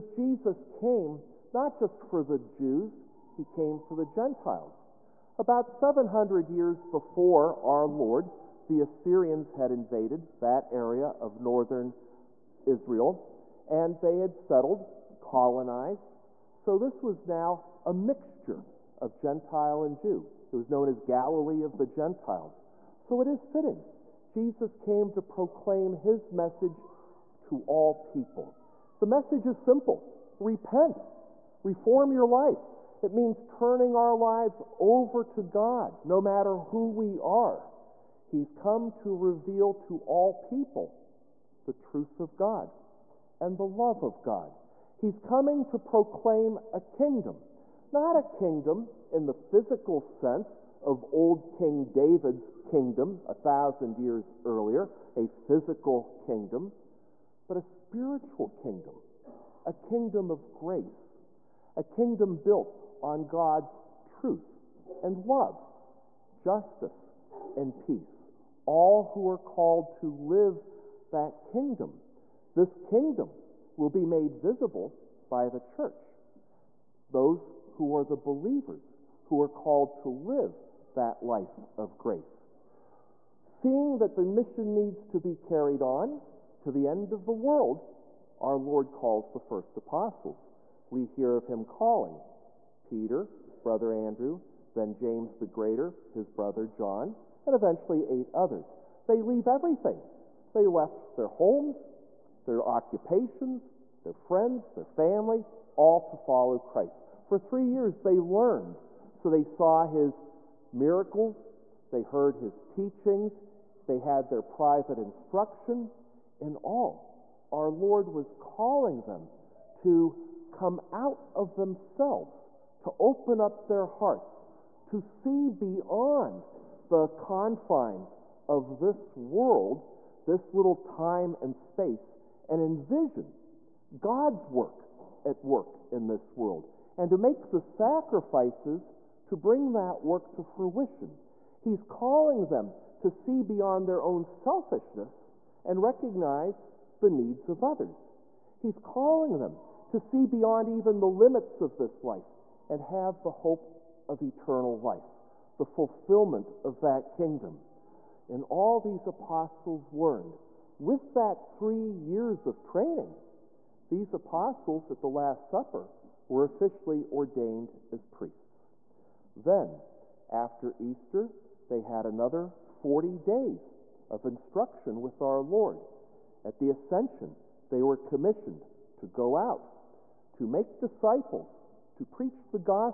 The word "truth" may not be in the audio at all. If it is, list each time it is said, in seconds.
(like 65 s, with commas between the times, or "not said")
41 s, 64 s.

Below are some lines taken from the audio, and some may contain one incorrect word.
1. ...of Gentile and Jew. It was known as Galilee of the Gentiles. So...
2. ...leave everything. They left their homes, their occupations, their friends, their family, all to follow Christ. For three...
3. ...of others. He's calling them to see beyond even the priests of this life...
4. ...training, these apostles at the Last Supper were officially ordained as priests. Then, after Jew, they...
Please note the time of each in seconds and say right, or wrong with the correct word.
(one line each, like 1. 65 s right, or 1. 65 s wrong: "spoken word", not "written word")
1. 18 s right
2. 99 s right
3. 147 s wrong: "limits", not "priests"
4. 162 s wrong: "Easter", not "Jew".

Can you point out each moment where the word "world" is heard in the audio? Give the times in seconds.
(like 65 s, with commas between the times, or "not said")
87 s, 129 s, 136 s.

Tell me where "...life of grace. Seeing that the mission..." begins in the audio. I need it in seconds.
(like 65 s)
81 s.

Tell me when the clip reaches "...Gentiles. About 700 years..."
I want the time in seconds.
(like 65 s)
4 s.